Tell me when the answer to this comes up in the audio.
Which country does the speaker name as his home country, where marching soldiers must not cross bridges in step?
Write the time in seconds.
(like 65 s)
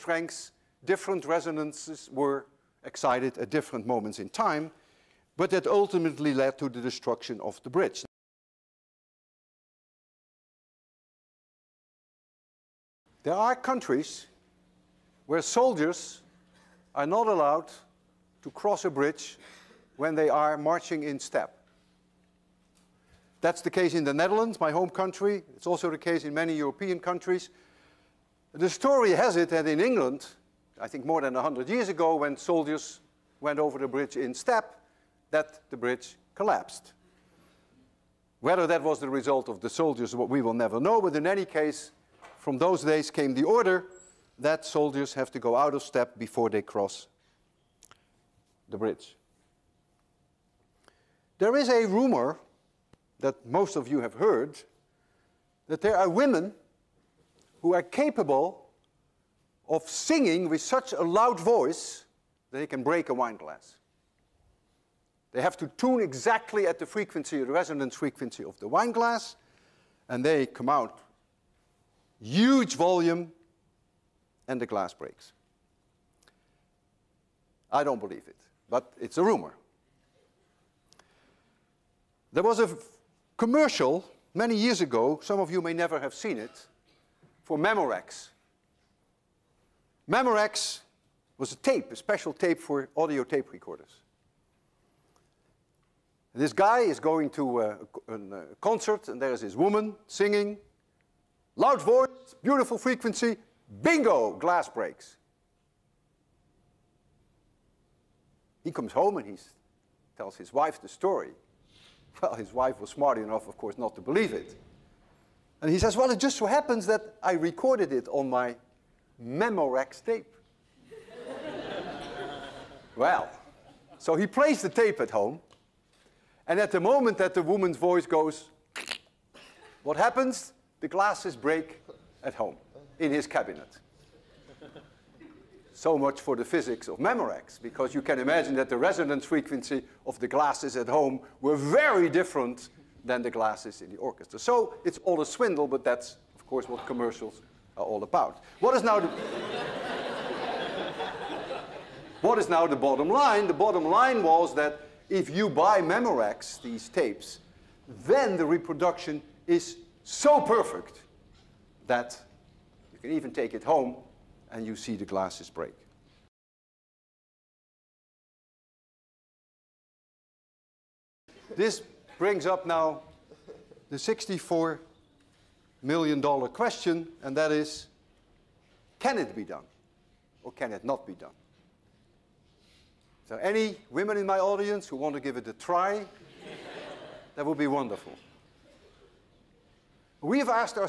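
24 s.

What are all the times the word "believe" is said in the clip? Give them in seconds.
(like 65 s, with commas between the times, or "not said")
77 s, 114 s.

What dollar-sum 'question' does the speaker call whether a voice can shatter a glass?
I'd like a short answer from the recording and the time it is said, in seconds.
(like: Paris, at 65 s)
$64 million, at 173 s.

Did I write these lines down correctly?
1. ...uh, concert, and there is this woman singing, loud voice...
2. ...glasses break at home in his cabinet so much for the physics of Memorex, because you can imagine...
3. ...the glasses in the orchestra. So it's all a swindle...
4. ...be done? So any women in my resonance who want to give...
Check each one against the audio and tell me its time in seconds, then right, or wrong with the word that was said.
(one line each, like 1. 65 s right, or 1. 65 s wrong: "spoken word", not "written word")
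1. 98 s right
2. 130 s right
3. 143 s right
4. 181 s wrong: "audience", not "resonance".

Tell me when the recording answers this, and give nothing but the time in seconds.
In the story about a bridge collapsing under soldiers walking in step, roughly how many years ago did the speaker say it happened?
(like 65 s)
31 s.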